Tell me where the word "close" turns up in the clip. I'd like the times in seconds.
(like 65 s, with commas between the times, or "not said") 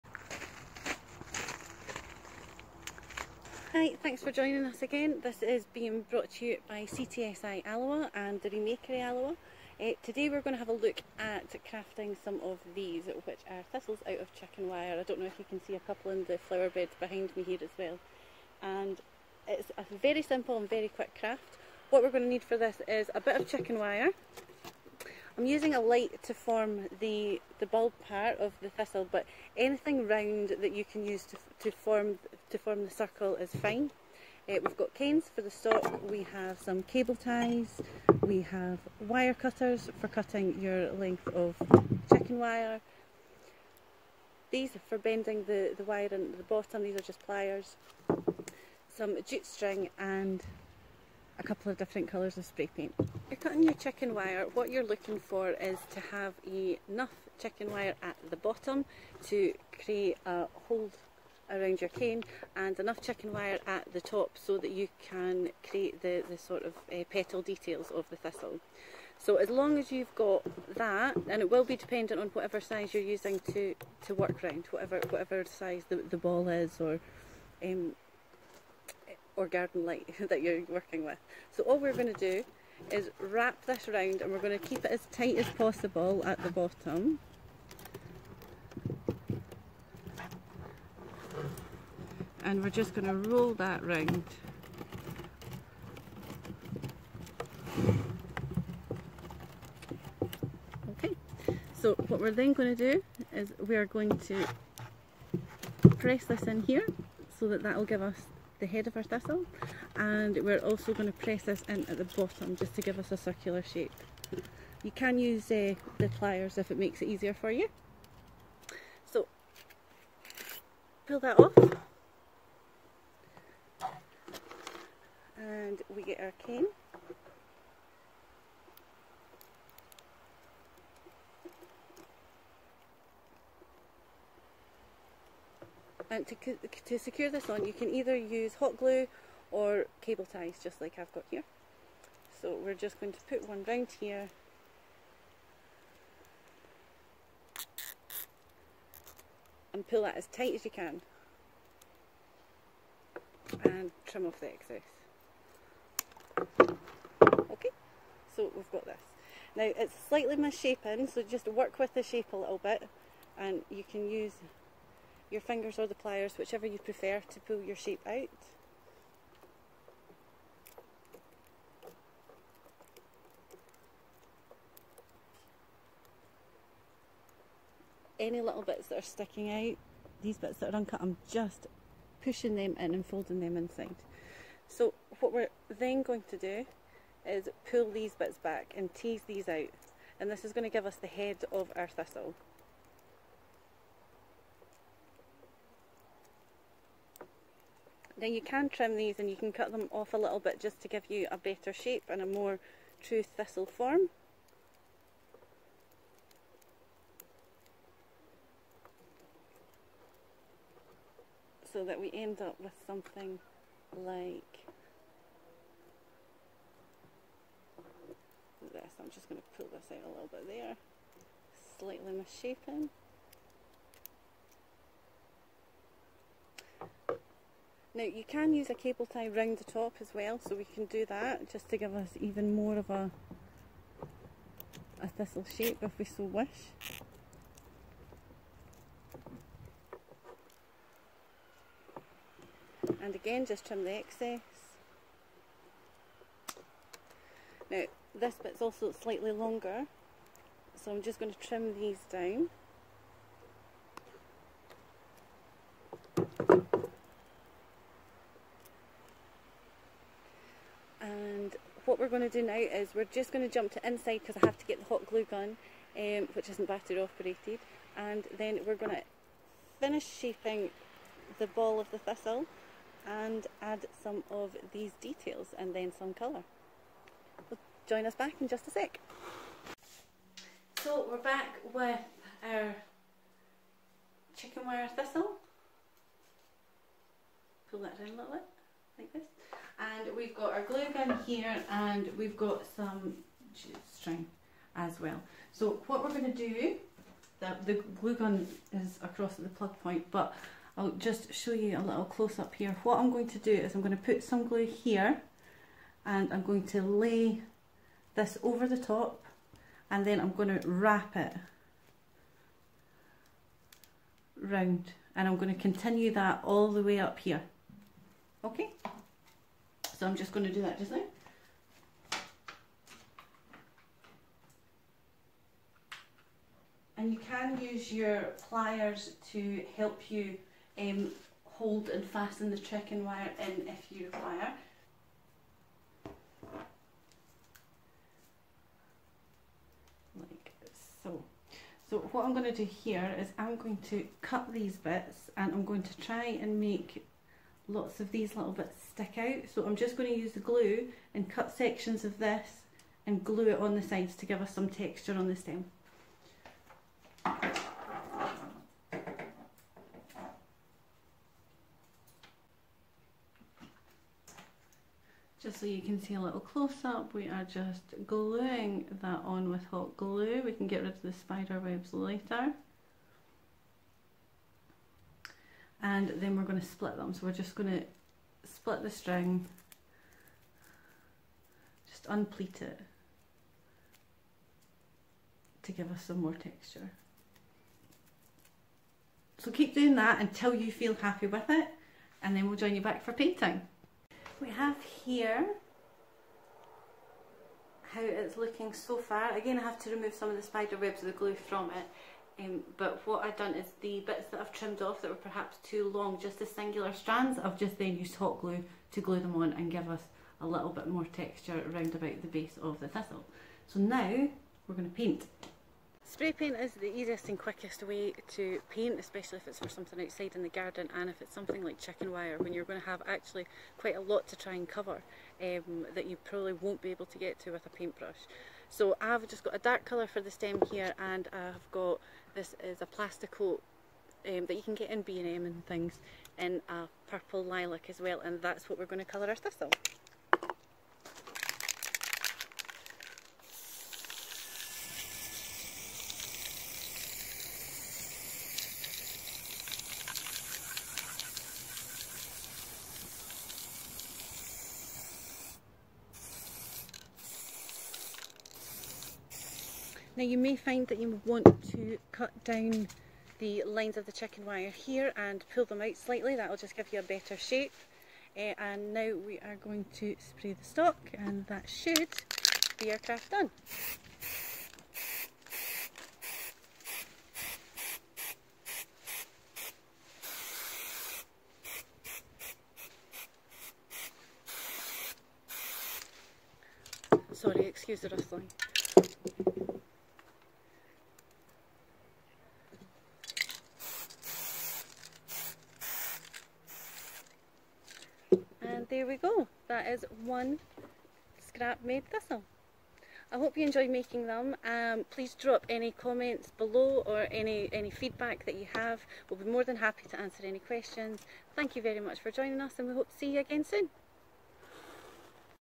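302 s, 366 s.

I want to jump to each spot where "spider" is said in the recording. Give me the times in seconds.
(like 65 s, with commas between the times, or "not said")
371 s, 400 s.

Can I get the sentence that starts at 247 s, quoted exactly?
Now this bit's also slightly longer, so I'm just going to trim these down.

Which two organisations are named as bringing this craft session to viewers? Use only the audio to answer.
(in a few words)
CTSI Alloa and the Remakery Alloa.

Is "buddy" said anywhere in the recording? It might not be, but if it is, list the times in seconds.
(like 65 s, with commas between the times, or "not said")
not said.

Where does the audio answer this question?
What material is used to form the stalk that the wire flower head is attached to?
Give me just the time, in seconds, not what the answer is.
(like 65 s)
34 s.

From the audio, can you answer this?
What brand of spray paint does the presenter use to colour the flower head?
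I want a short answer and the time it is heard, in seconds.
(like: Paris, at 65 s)
PlastiKote, at 432 s.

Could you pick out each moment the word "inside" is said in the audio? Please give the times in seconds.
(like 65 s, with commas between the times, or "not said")
183 s, 263 s.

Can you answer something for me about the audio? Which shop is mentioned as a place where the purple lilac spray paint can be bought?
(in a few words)
B&M.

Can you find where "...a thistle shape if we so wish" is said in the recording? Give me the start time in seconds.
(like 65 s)
235 s.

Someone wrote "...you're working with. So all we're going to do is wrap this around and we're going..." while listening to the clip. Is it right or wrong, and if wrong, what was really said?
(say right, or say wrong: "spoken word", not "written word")
right.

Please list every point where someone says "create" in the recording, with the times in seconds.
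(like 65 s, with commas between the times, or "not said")
59 s, 65 s.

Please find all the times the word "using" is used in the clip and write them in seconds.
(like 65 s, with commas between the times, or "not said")
25 s, 73 s.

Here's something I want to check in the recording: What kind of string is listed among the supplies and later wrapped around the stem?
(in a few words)
Jute string.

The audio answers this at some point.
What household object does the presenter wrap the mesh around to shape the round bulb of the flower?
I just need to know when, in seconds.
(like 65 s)
25 s.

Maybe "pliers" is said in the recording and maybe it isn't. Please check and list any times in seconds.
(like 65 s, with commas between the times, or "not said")
47 s, 116 s, 165 s, 328 s.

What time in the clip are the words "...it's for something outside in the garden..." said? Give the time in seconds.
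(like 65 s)
419 s.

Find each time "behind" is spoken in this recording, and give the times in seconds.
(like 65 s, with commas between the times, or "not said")
16 s.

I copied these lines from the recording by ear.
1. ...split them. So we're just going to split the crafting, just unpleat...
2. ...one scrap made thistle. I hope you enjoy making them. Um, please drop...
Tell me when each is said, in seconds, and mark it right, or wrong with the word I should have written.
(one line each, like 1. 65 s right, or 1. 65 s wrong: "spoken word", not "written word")
1. 376 s wrong: "string", not "crafting"
2. 500 s right.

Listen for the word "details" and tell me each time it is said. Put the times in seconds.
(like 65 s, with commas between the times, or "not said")
67 s, 275 s.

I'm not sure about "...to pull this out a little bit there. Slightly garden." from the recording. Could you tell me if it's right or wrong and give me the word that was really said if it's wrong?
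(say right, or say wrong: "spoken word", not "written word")
wrong: "misshapen", not "garden".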